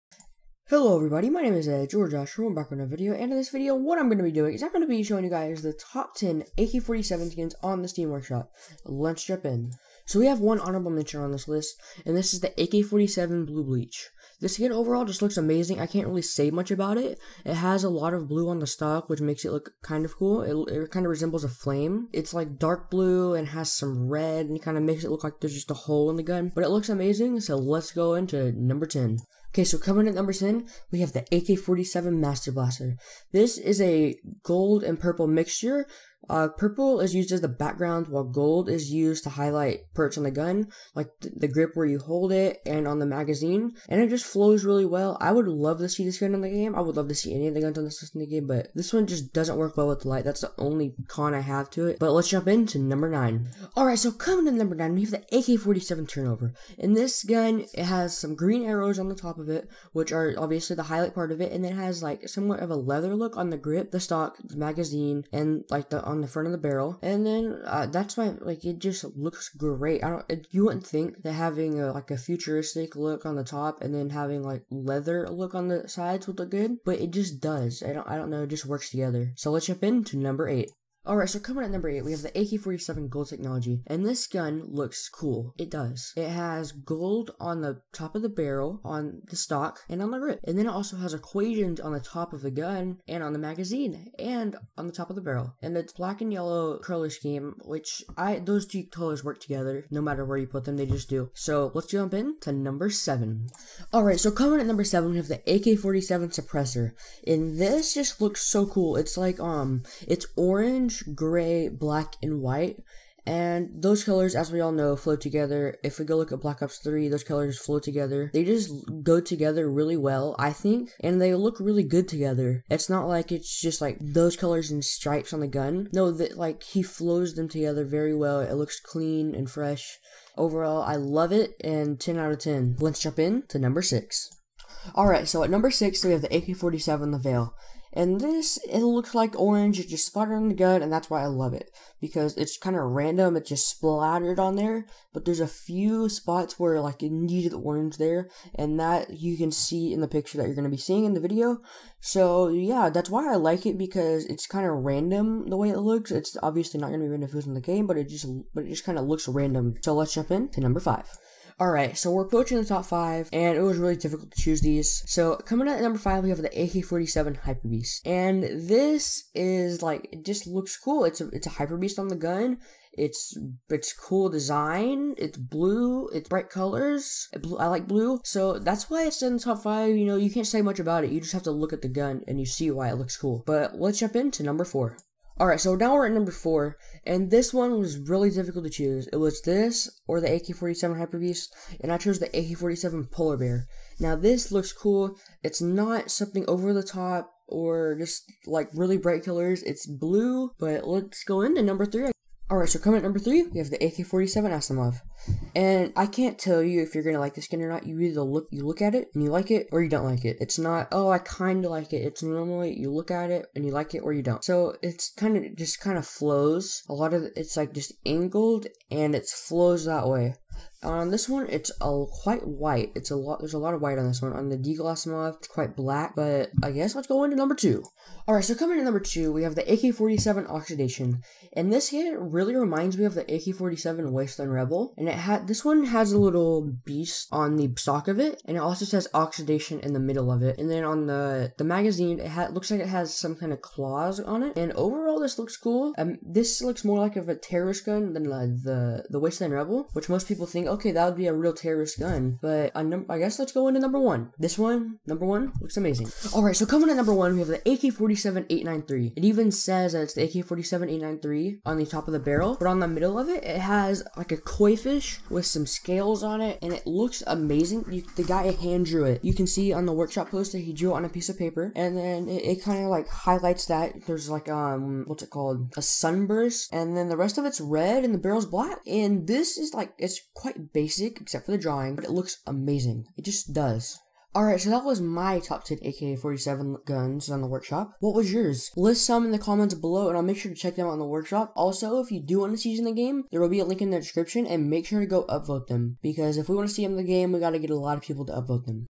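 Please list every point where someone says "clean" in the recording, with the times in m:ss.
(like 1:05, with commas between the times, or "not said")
2:08.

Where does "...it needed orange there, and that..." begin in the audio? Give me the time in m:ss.
2:27.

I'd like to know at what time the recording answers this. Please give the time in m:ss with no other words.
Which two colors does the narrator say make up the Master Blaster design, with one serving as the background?
0:34.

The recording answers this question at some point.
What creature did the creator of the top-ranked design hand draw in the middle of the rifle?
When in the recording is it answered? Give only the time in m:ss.
4:24.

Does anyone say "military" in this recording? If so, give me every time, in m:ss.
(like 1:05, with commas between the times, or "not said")
not said.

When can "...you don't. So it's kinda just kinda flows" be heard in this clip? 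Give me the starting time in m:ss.
3:34.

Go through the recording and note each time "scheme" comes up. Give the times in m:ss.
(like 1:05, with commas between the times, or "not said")
1:37.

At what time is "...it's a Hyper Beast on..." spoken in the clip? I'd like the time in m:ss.
2:51.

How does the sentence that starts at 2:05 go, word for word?
No, that like he flows them together very well.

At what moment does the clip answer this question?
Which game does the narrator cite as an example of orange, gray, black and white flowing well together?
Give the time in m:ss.
1:56.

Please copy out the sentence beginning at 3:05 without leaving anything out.
Alright, so now we're at number 4, and this one was really difficult to choose.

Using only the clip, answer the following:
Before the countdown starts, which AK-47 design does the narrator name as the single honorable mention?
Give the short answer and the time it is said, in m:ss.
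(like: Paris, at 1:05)
Blue Bleach, at 0:13.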